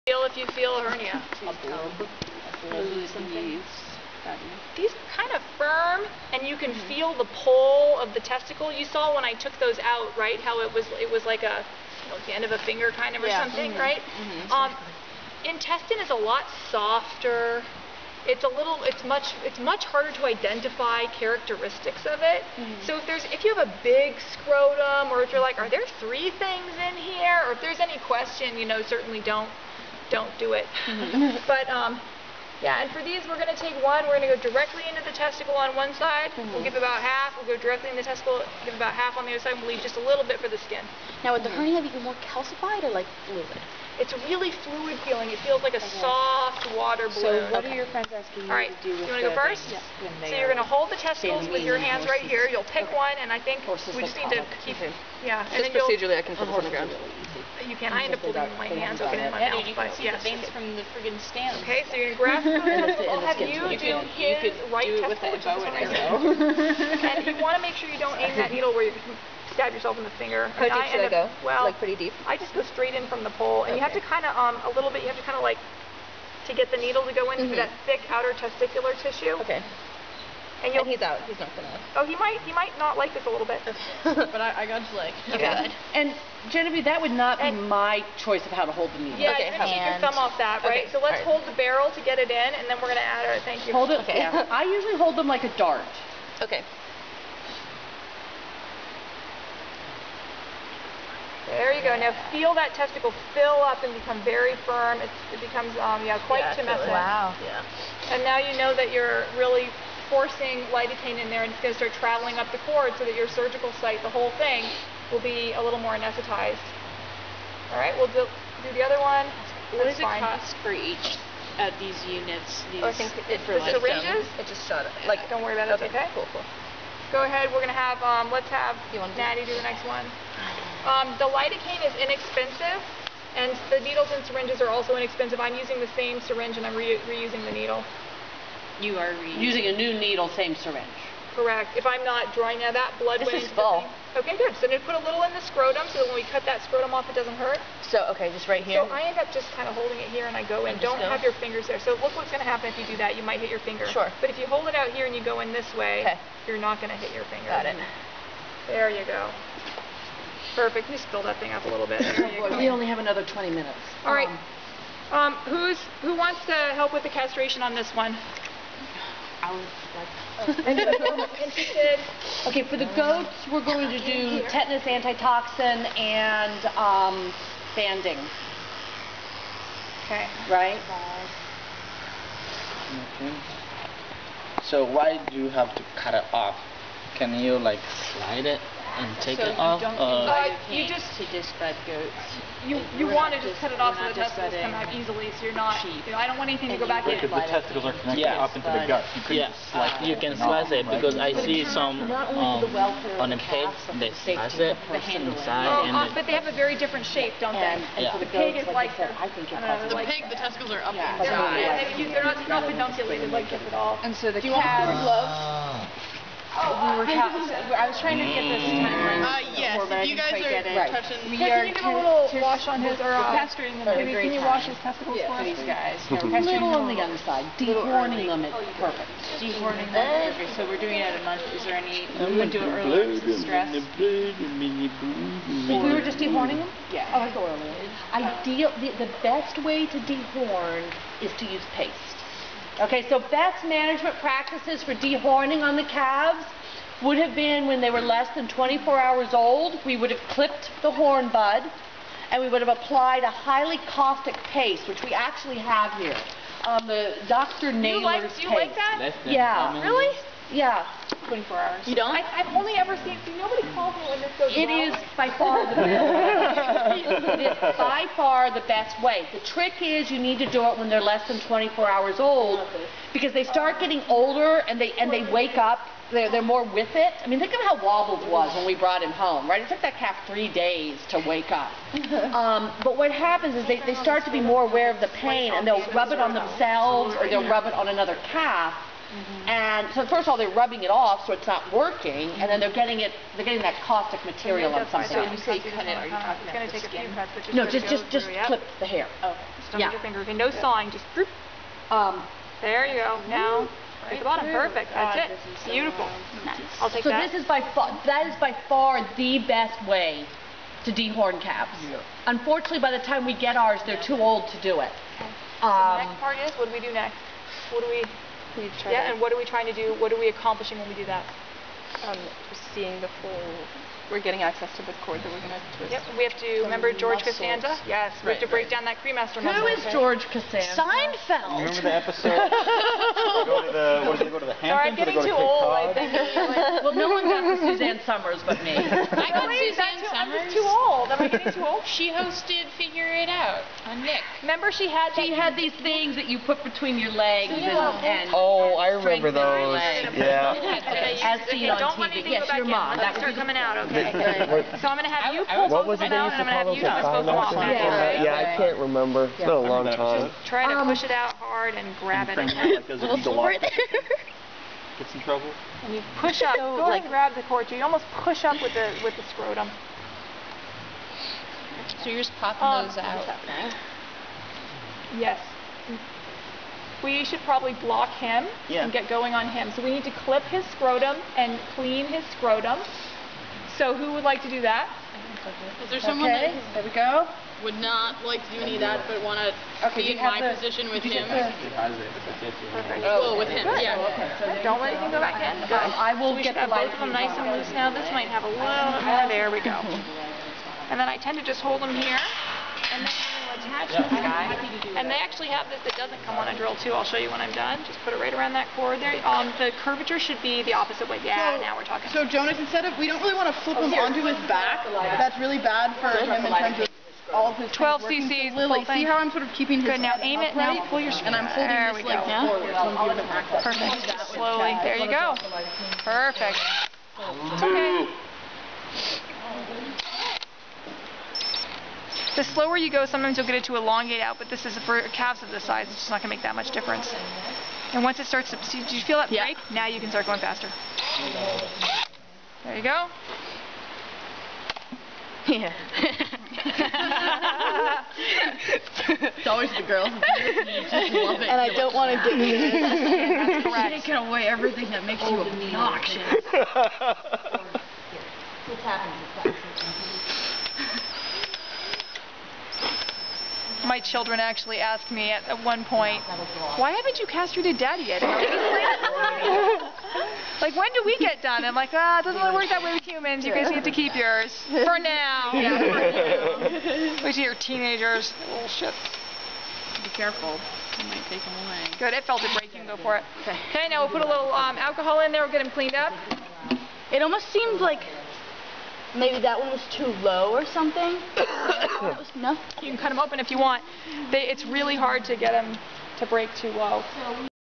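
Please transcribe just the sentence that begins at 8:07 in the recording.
It almost seemed like maybe that one was too low or something.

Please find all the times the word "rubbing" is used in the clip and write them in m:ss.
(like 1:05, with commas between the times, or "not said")
4:50.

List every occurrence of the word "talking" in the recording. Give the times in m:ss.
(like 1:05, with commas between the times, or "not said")
4:56, 6:51.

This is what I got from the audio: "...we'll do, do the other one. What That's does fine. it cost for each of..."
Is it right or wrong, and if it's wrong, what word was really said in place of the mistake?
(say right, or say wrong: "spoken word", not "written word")
right.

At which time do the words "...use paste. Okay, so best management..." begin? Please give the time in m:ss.
4:01.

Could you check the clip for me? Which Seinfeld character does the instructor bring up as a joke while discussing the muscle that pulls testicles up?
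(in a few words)
George Costanza.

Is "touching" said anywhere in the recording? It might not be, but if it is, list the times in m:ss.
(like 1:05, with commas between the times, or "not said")
3:40.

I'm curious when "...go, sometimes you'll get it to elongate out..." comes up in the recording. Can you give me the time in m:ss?
7:12.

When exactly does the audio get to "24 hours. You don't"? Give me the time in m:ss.
4:21.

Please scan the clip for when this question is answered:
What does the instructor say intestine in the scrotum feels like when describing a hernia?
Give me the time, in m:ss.
0:46.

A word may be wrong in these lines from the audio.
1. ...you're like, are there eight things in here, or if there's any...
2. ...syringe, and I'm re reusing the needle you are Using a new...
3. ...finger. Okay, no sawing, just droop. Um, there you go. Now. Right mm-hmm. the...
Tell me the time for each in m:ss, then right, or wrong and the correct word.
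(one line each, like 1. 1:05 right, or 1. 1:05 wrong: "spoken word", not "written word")
1. 0:25 wrong: "three", not "eight"
2. 2:16 right
3. 4:59 right.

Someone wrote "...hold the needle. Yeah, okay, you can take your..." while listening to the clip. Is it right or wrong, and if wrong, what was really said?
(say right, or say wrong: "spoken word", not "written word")
right.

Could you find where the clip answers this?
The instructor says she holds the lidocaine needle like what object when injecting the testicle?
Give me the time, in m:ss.
1:35.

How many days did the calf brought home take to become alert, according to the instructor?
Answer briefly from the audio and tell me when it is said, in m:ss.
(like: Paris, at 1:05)
3, at 4:40.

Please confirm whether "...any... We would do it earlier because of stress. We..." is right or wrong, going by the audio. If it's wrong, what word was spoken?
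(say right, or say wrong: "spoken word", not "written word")
right.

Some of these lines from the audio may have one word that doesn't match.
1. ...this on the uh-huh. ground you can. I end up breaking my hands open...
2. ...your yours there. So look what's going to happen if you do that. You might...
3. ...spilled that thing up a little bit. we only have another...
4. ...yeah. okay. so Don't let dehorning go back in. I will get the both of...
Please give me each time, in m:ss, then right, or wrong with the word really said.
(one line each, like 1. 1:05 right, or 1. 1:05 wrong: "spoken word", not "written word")
1. 0:56 wrong: "holding", not "breaking"
2. 2:31 wrong: "fingers", not "yours"
3. 2:41 right
4. 6:33 wrong: "anything", not "dehorning".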